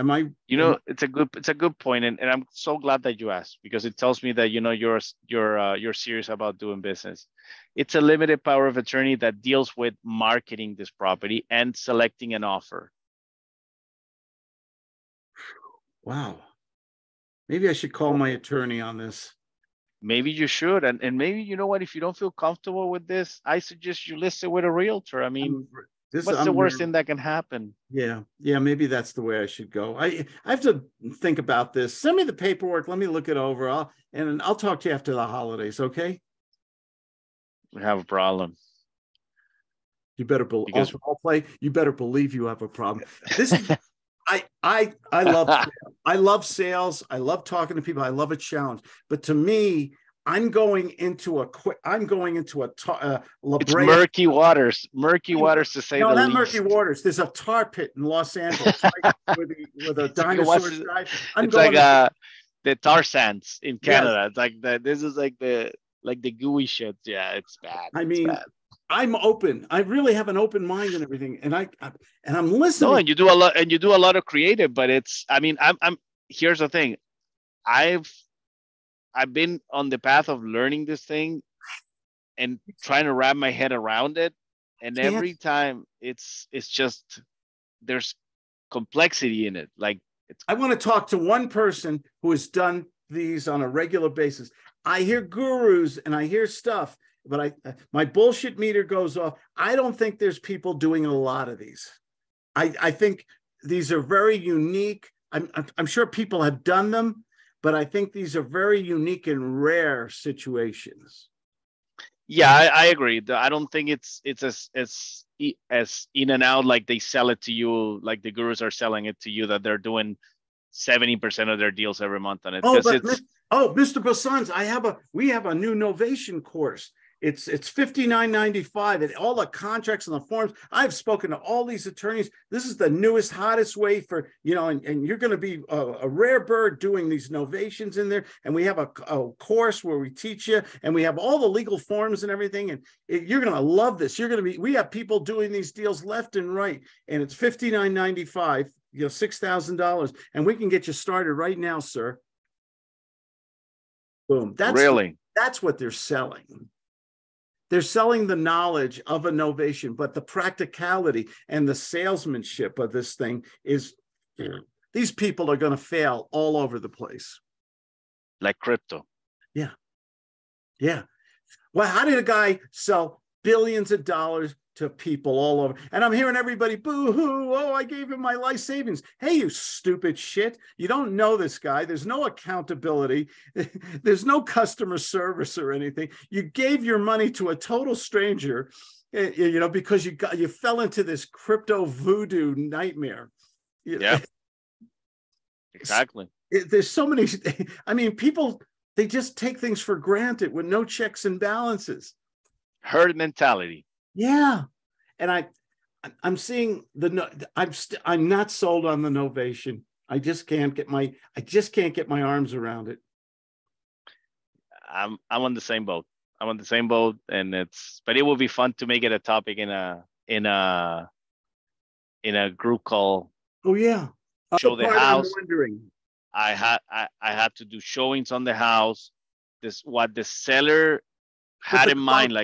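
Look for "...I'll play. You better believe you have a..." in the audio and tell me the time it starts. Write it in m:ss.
0:41.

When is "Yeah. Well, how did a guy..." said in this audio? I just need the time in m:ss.
2:50.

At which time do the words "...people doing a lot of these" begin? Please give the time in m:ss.
1:40.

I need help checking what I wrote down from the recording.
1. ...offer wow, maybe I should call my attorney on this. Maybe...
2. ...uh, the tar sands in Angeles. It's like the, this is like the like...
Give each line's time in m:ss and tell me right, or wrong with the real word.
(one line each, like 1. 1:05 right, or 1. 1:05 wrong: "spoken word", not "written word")
1. 0:12 right
2. 1:01 wrong: "Canada", not "Angeles".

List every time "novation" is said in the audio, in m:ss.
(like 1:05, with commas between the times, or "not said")
2:05, 2:17, 2:39, 3:29.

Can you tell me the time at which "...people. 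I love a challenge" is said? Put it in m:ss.
0:47.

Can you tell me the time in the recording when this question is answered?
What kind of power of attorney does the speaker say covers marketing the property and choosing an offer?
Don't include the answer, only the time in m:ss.
0:08.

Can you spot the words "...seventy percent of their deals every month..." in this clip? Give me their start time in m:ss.
2:00.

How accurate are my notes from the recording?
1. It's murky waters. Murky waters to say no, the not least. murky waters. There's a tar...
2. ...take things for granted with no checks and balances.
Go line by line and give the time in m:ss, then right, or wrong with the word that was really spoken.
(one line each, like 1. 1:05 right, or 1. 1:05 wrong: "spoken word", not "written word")
1. 0:53 right
2. 3:19 right.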